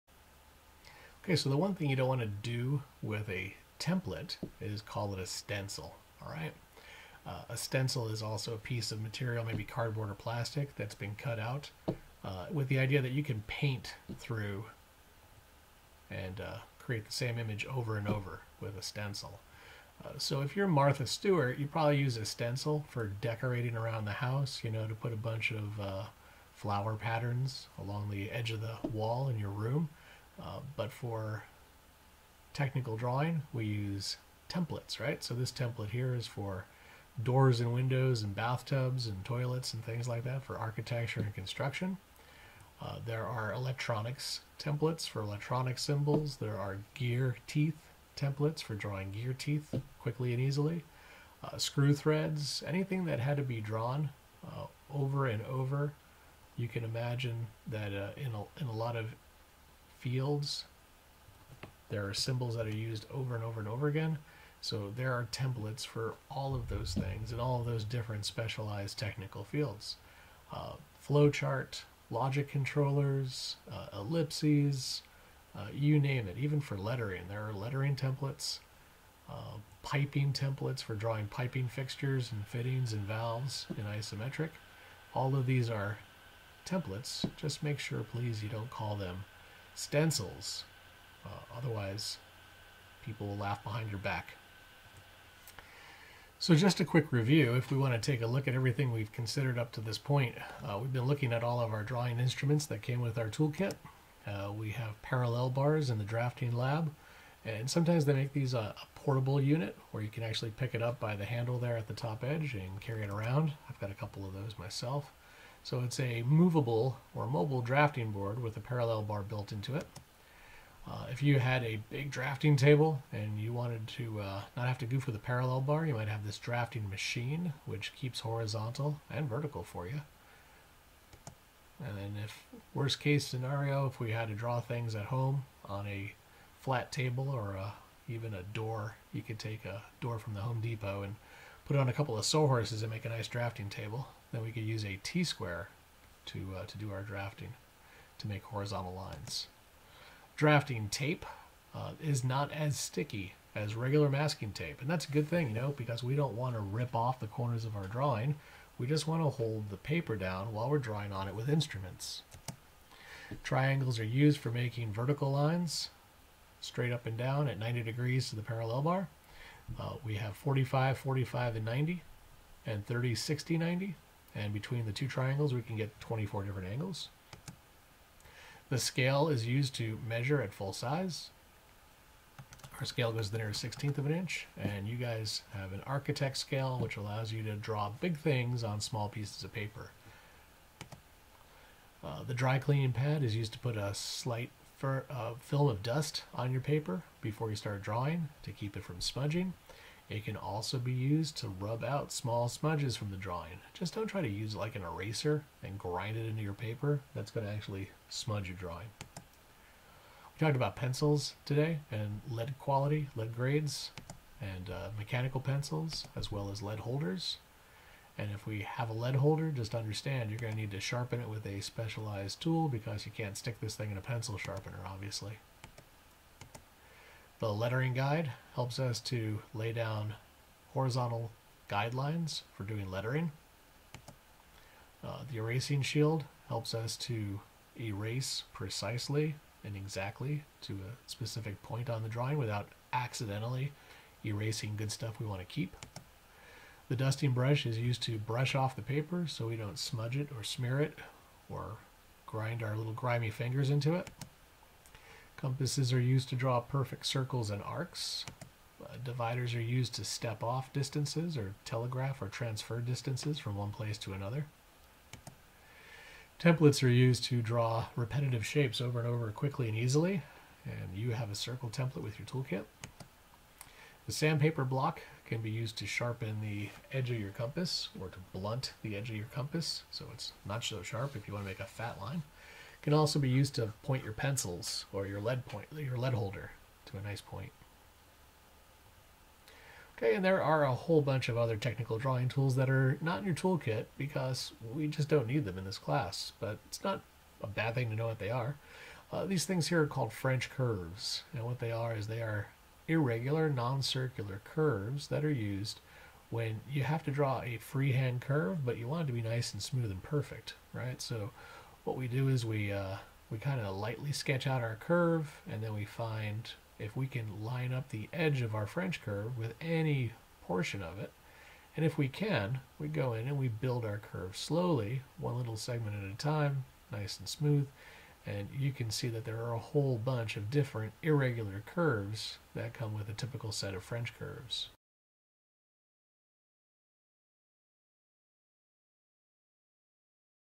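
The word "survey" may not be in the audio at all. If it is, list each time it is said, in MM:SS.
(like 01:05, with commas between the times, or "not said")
not said.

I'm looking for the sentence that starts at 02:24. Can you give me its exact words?
Then we could use a T-square to, uh, to do our drafting, to make horizontal lines.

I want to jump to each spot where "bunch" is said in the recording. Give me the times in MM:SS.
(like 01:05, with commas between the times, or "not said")
00:25, 04:51, 05:29.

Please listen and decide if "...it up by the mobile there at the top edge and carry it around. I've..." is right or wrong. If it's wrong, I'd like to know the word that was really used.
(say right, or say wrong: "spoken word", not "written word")
wrong: "handle", not "mobile".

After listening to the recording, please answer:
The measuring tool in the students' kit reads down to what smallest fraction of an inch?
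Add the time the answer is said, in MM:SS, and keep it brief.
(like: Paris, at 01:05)
16th of an inch, at 03:03.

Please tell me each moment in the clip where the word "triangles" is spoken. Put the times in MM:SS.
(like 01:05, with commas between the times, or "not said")
02:43, 02:55.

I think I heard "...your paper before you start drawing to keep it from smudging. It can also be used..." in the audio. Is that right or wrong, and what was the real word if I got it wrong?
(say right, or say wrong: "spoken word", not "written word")
right.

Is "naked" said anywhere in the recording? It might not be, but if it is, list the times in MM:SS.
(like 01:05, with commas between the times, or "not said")
not said.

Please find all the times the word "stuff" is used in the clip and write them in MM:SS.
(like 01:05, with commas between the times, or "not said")
04:04.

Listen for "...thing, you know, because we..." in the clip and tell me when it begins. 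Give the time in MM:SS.
02:35.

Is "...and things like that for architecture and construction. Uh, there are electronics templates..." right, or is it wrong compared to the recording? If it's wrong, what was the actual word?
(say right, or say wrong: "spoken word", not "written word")
right.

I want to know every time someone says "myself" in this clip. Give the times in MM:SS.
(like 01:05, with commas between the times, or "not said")
01:54.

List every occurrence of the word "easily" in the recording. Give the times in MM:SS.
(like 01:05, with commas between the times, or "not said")
00:50, 04:29.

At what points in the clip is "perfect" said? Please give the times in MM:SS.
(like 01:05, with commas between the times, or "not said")
04:16, 05:10.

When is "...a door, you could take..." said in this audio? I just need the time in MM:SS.
02:18.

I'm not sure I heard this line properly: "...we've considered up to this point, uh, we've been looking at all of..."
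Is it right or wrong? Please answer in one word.
right.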